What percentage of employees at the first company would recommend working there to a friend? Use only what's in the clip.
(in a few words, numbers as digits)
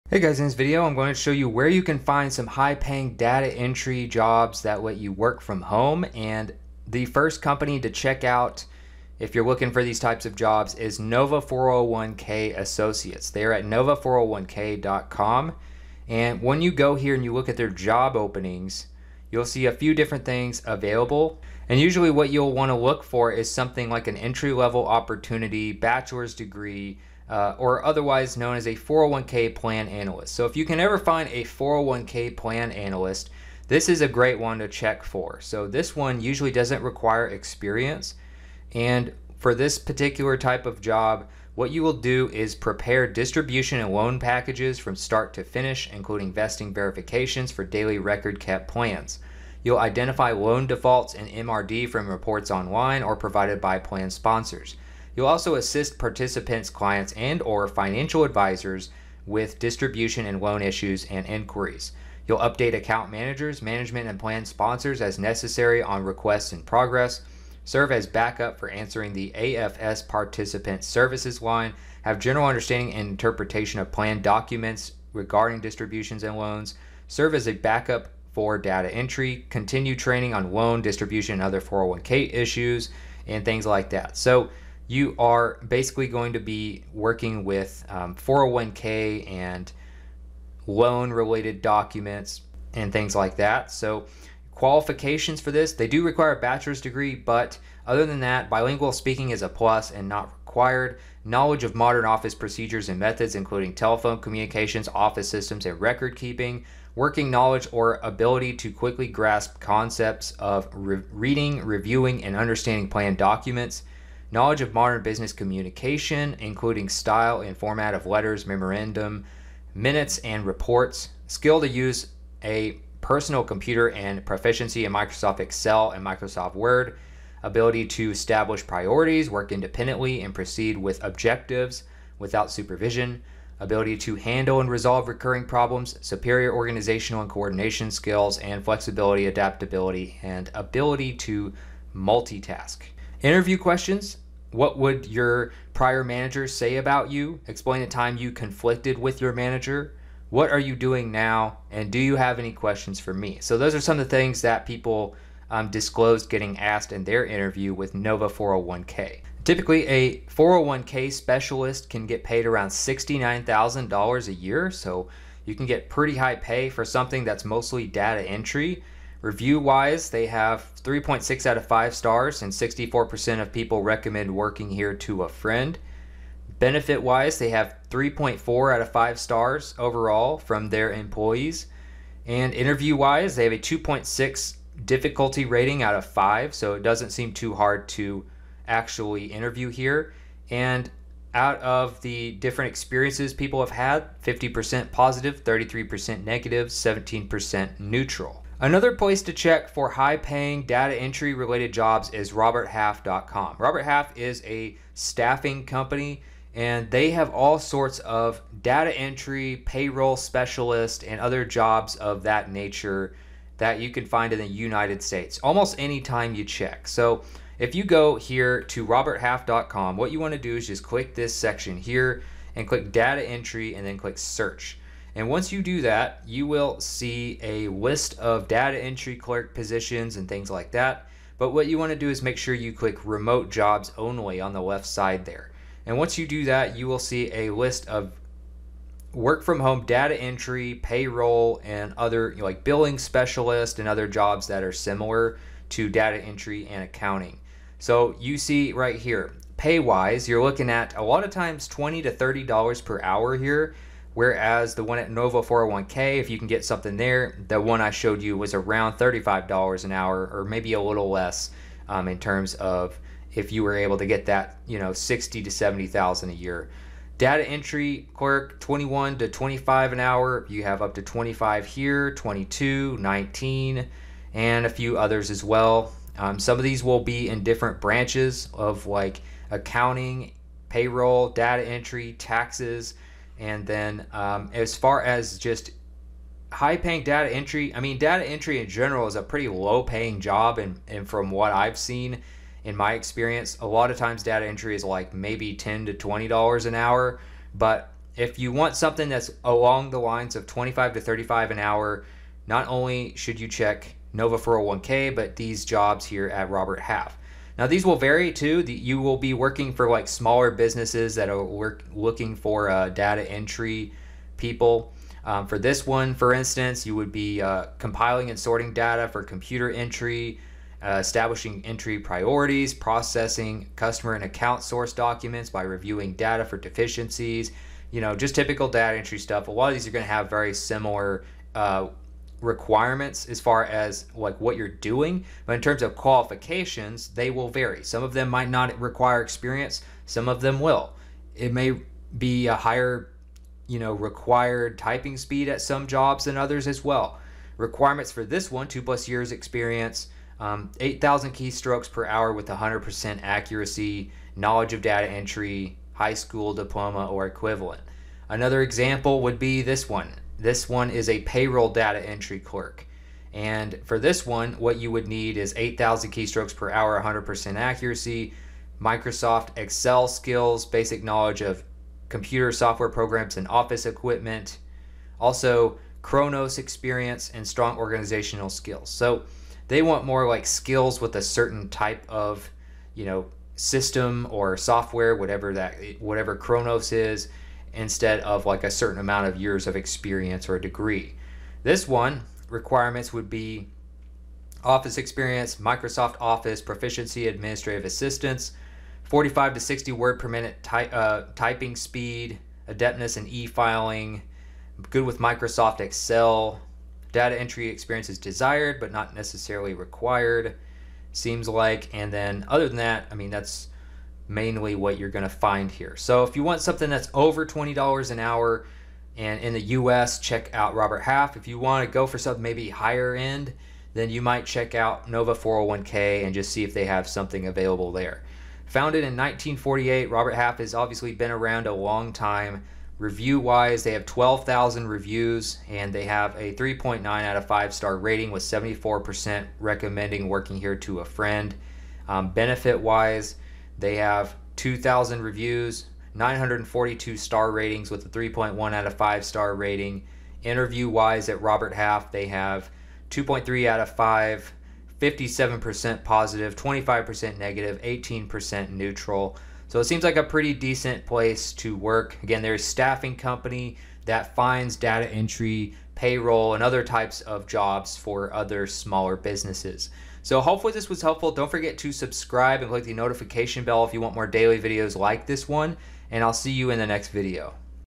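64%.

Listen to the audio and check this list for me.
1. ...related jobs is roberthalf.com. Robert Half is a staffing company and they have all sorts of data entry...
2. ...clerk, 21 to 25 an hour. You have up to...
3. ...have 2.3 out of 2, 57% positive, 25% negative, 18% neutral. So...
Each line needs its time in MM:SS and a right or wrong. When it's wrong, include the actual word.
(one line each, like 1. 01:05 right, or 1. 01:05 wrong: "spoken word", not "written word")
1. 03:21 right
2. 04:28 right
3. 07:32 wrong: "5", not "2".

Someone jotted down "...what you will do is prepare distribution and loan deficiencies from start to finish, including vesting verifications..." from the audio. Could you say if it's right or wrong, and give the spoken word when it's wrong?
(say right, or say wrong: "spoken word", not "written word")
wrong: "packages", not "deficiencies".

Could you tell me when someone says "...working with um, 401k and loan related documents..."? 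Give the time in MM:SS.
01:26.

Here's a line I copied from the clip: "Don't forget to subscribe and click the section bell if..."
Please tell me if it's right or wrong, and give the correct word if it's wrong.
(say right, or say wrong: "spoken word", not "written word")
wrong: "notification", not "section".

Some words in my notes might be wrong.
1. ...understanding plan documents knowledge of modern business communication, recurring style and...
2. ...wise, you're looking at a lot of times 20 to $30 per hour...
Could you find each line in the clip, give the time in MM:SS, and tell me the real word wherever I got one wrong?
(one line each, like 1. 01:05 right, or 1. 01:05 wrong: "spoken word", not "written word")
1. 01:52 wrong: "including", not "recurring"
2. 04:09 right.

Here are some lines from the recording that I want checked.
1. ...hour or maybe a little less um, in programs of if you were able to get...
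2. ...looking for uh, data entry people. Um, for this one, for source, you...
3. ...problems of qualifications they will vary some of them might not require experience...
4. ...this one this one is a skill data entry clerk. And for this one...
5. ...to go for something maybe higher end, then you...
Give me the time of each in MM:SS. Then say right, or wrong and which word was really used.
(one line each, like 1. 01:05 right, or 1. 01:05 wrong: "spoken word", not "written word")
1. 04:19 wrong: "terms", not "programs"
2. 05:11 wrong: "instance", not "source"
3. 05:35 wrong: "terms", not "problems"
4. 05:59 wrong: "payroll", not "skill"
5. 07:01 right.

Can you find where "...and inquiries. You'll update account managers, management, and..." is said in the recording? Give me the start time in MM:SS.
01:01.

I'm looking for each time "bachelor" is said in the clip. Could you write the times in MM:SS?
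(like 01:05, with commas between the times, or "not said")
00:25, 01:36.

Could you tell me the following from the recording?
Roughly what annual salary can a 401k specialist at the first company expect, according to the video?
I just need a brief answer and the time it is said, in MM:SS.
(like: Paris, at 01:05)
$69,000, at 02:42.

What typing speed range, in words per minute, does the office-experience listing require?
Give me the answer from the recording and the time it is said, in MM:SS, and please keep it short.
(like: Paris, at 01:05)
45 to 60, at 06:39.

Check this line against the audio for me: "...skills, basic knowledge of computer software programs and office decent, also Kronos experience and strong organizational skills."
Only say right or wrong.
wrong.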